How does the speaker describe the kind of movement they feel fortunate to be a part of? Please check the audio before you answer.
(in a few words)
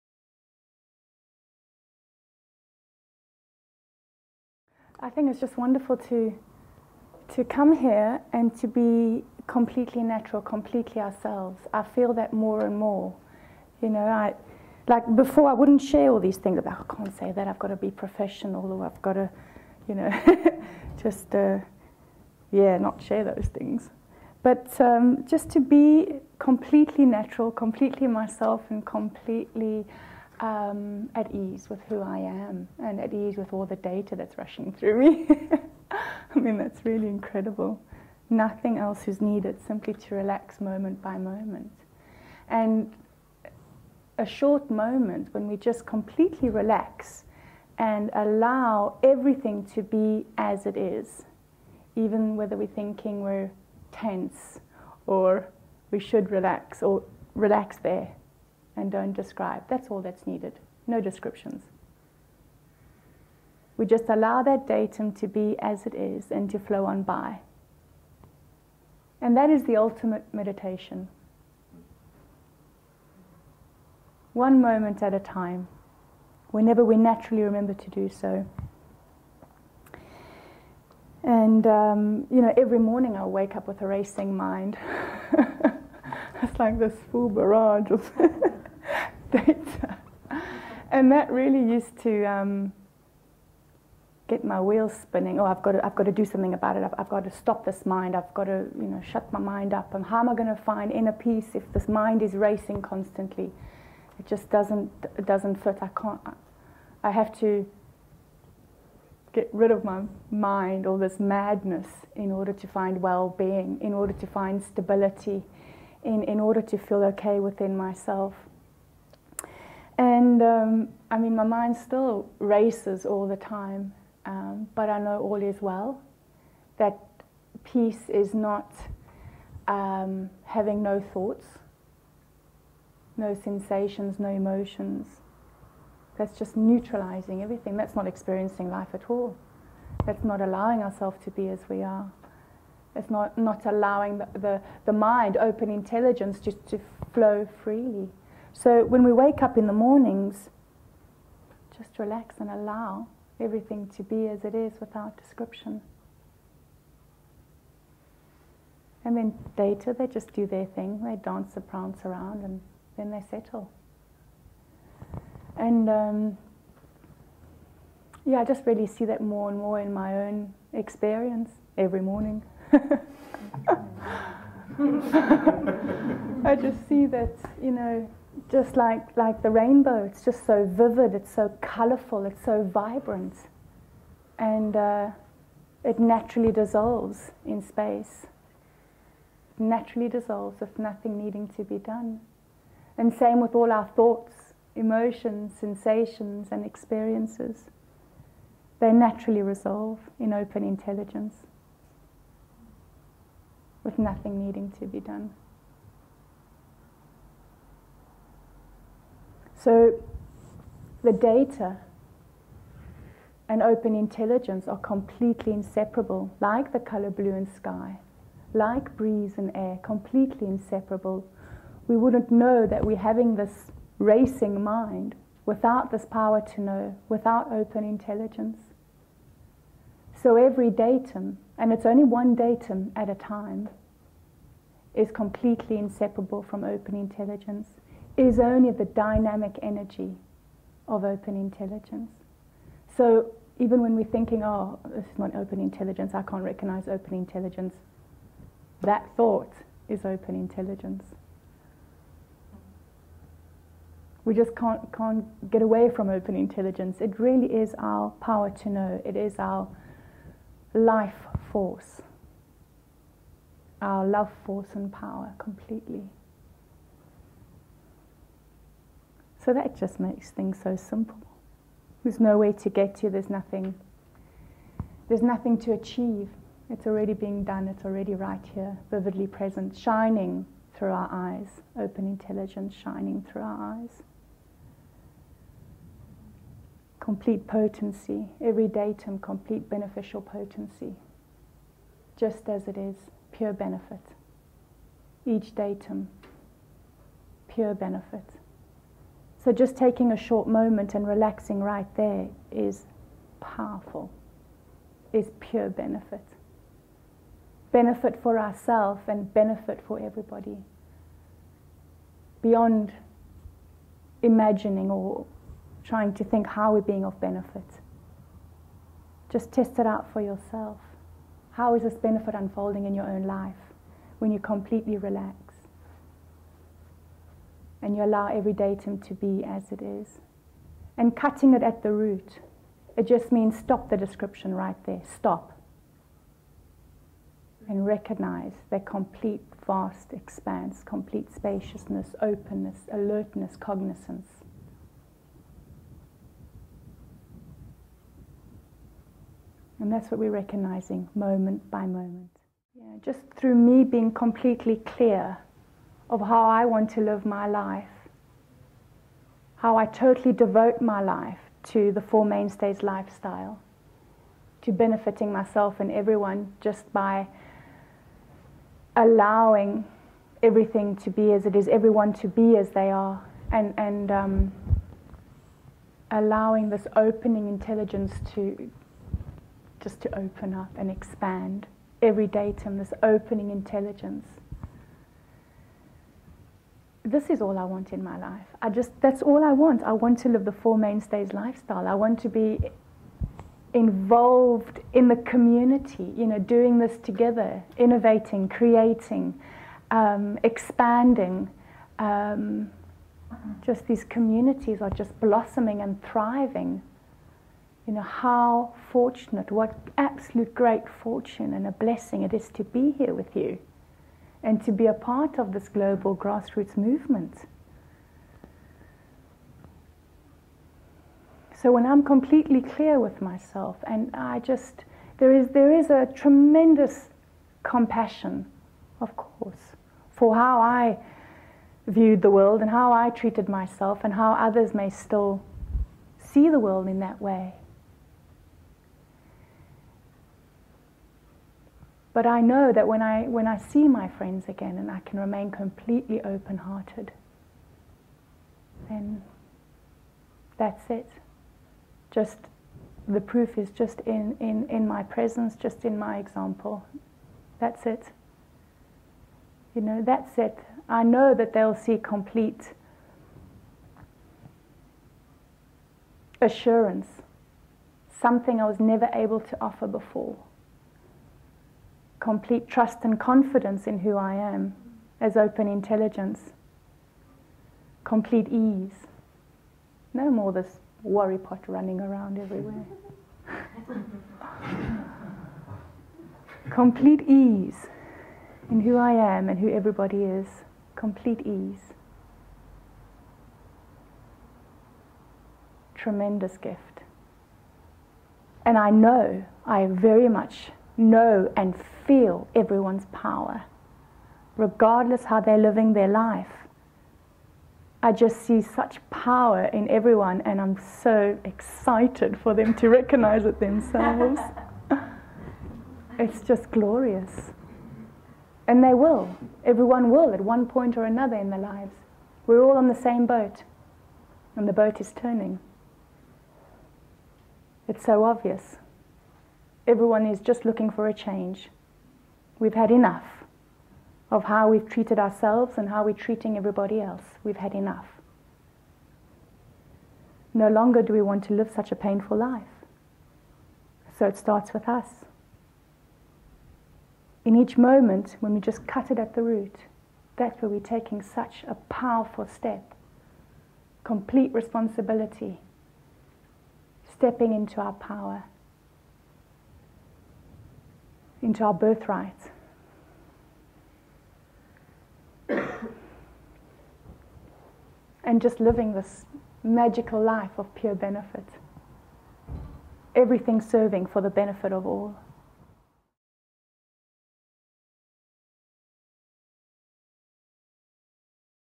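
global grassroots movement.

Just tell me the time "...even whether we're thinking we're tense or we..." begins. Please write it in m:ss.
0:51.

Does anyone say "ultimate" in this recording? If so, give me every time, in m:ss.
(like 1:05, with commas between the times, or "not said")
1:09.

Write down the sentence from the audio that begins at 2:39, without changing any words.
And then later they just do their thing, they dance and prance around and then they settle.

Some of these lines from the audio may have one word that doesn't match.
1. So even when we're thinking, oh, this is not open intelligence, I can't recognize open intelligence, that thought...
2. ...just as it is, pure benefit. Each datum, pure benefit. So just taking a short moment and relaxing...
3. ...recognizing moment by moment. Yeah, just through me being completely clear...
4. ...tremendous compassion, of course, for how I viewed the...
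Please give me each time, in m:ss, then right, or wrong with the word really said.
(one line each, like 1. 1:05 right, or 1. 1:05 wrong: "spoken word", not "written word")
1. 4:02 right
2. 4:52 right
3. 5:50 right
4. 7:06 right.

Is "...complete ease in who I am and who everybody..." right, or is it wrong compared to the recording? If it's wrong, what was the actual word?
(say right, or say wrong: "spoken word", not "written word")
right.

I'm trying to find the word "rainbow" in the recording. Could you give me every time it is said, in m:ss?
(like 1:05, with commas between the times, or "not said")
2:59.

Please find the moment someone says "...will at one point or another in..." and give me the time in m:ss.
8:40.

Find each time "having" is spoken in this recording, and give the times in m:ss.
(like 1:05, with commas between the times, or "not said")
2:10, 3:42.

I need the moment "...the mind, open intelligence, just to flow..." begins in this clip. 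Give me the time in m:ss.
2:24.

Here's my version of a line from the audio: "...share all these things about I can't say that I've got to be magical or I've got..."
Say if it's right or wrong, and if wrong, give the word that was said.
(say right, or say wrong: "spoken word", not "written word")
wrong: "professional", not "magical".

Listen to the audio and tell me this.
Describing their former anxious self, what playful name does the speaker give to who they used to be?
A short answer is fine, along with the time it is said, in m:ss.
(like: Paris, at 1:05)
worry pot, at 8:01.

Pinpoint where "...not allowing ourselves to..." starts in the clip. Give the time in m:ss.
2:20.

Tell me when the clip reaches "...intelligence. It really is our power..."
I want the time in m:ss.
4:16.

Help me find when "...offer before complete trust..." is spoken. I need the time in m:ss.
7:49.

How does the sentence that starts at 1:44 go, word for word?
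It just doesn't, it doesn't fit.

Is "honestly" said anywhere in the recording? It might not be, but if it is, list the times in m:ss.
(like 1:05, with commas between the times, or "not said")
not said.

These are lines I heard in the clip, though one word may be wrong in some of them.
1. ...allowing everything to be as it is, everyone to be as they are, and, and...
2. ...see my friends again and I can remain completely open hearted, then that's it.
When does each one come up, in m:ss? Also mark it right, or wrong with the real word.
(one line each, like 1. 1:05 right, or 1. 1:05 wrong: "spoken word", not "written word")
1. 6:08 right
2. 7:23 right.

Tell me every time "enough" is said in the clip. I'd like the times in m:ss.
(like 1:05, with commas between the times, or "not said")
8:52, 8:57.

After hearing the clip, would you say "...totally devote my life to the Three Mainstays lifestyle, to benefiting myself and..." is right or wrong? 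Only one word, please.
wrong.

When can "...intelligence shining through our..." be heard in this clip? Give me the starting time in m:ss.
4:42.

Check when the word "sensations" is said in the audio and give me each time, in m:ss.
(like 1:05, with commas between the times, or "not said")
2:13, 3:15.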